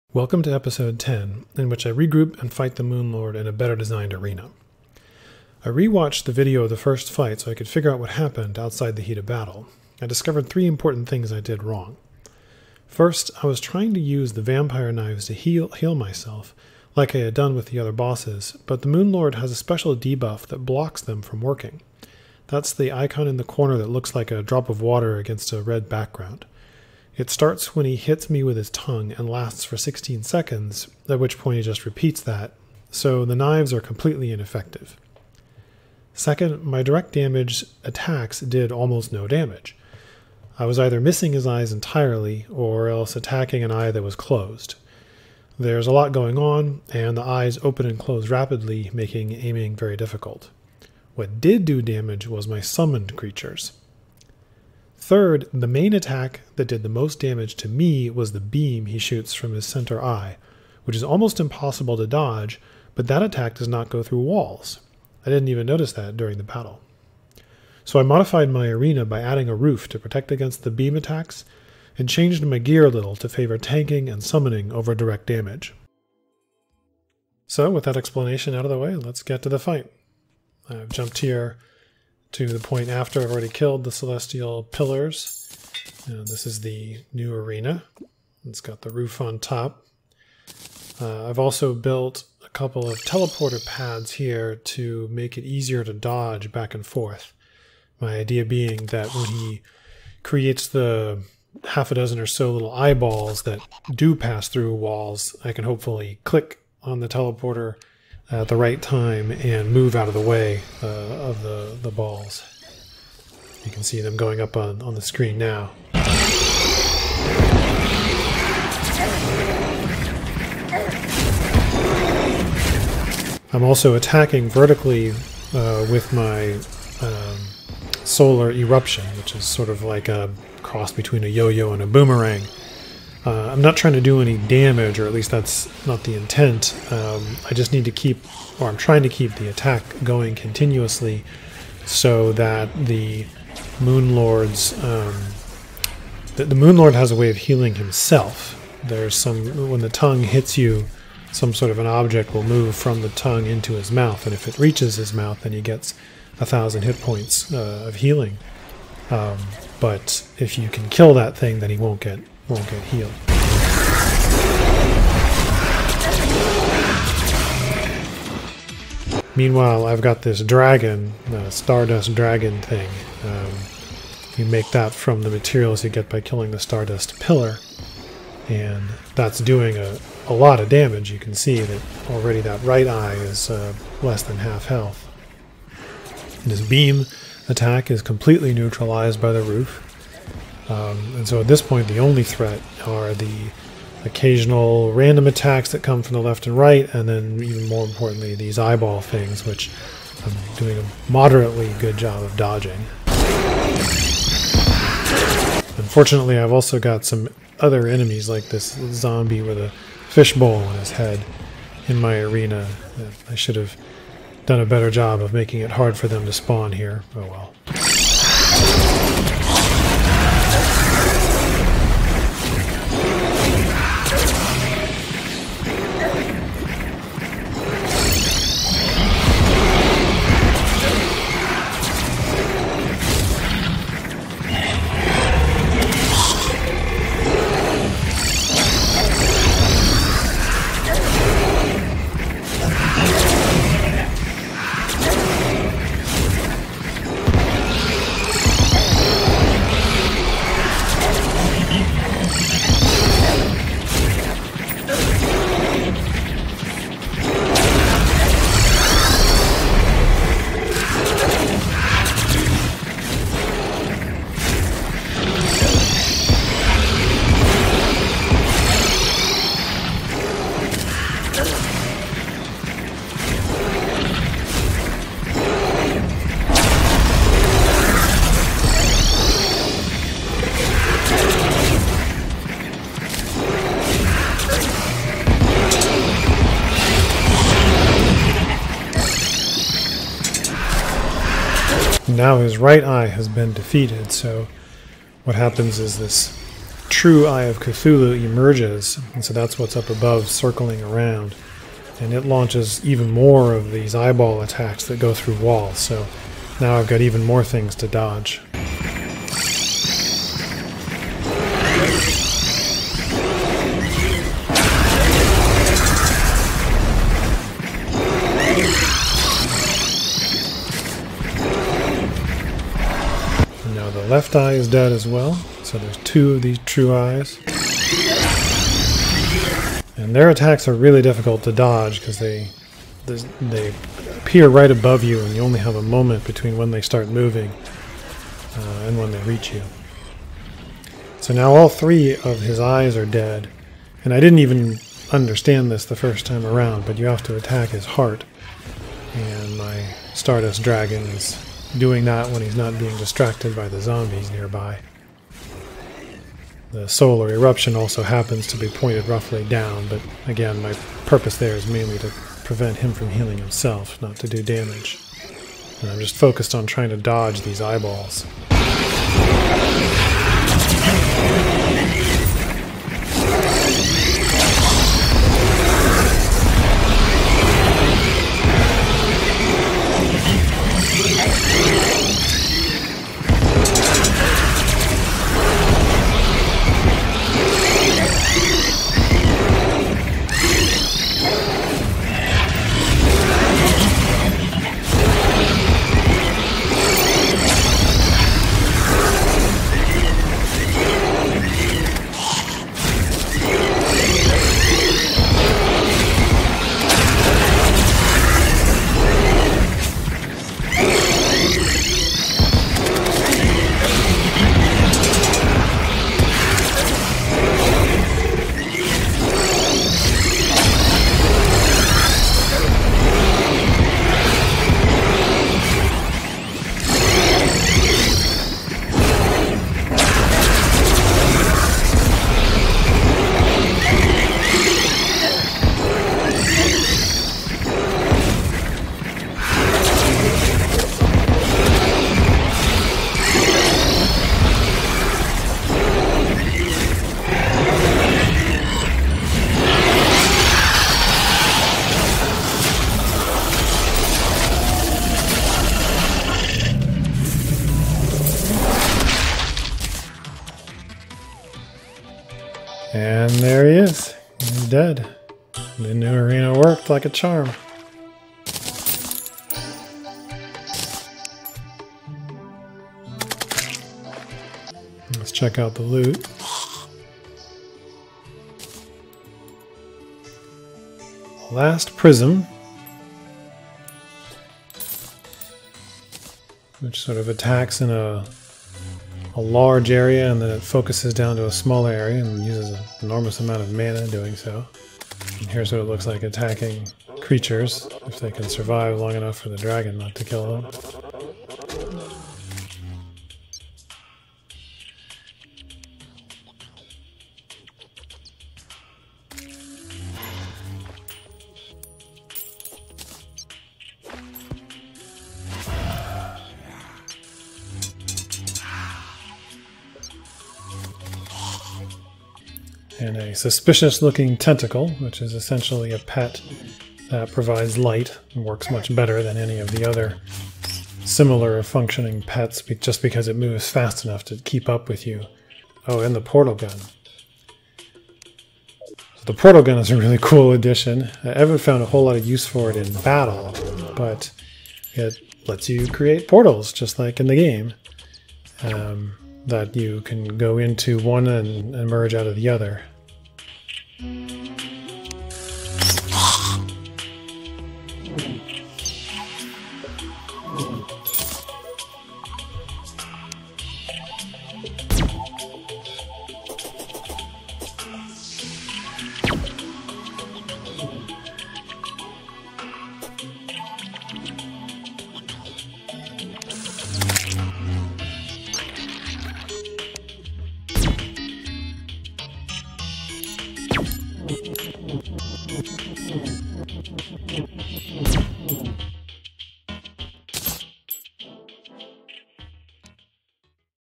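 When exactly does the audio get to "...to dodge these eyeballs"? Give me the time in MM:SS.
06:06.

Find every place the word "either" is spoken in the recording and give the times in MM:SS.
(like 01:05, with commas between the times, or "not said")
00:40.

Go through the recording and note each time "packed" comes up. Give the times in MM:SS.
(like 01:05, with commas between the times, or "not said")
not said.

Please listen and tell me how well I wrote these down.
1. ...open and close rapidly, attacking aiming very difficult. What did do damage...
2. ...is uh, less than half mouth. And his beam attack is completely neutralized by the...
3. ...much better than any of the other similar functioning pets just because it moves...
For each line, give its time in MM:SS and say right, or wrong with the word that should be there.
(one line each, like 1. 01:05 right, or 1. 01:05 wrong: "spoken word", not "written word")
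1. 00:47 wrong: "making", not "attacking"
2. 03:03 wrong: "health", not "mouth"
3. 08:48 right.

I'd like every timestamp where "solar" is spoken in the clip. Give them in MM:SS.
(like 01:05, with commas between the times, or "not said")
02:08, 05:56.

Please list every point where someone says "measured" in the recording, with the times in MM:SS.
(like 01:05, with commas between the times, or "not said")
not said.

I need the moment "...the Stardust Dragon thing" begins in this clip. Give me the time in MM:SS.
02:51.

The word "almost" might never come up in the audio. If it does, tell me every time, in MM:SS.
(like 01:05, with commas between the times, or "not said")
00:38, 01:01.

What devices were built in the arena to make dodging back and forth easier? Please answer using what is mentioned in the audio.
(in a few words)
teleporter pads.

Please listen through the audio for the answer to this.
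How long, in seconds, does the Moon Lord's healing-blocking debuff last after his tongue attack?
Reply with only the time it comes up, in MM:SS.
00:29.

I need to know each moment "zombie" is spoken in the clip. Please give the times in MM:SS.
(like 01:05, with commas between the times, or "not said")
03:28, 05:53.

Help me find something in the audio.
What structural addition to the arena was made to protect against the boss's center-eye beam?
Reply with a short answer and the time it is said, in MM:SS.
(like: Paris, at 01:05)
a roof, at 01:09.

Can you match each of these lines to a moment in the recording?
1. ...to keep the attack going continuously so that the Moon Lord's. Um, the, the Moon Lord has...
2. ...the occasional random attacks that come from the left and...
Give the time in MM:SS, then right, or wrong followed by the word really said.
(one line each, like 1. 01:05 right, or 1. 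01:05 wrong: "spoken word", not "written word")
1. 02:19 right
2. 03:13 right.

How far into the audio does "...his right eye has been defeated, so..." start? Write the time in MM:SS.
04:52.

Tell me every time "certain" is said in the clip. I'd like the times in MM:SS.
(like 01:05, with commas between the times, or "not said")
not said.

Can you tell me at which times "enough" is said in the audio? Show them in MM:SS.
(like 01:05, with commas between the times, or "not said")
08:19, 08:54.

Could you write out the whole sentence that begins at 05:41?
So now all three of his eyes are dead.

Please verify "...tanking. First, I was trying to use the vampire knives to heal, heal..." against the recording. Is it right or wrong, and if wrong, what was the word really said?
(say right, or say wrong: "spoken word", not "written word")
wrong: "wrong", not "tanking".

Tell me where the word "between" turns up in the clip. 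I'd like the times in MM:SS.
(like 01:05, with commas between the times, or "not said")
02:10, 05:36.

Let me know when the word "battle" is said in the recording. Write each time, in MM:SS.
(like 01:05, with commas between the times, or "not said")
00:09, 01:06, 09:03.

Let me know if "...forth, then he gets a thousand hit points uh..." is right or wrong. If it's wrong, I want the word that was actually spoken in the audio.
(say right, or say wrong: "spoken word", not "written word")
wrong: "mouth", not "forth".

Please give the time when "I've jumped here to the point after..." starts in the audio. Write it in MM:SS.
01:20.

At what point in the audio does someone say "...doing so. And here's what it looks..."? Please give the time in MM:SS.
08:14.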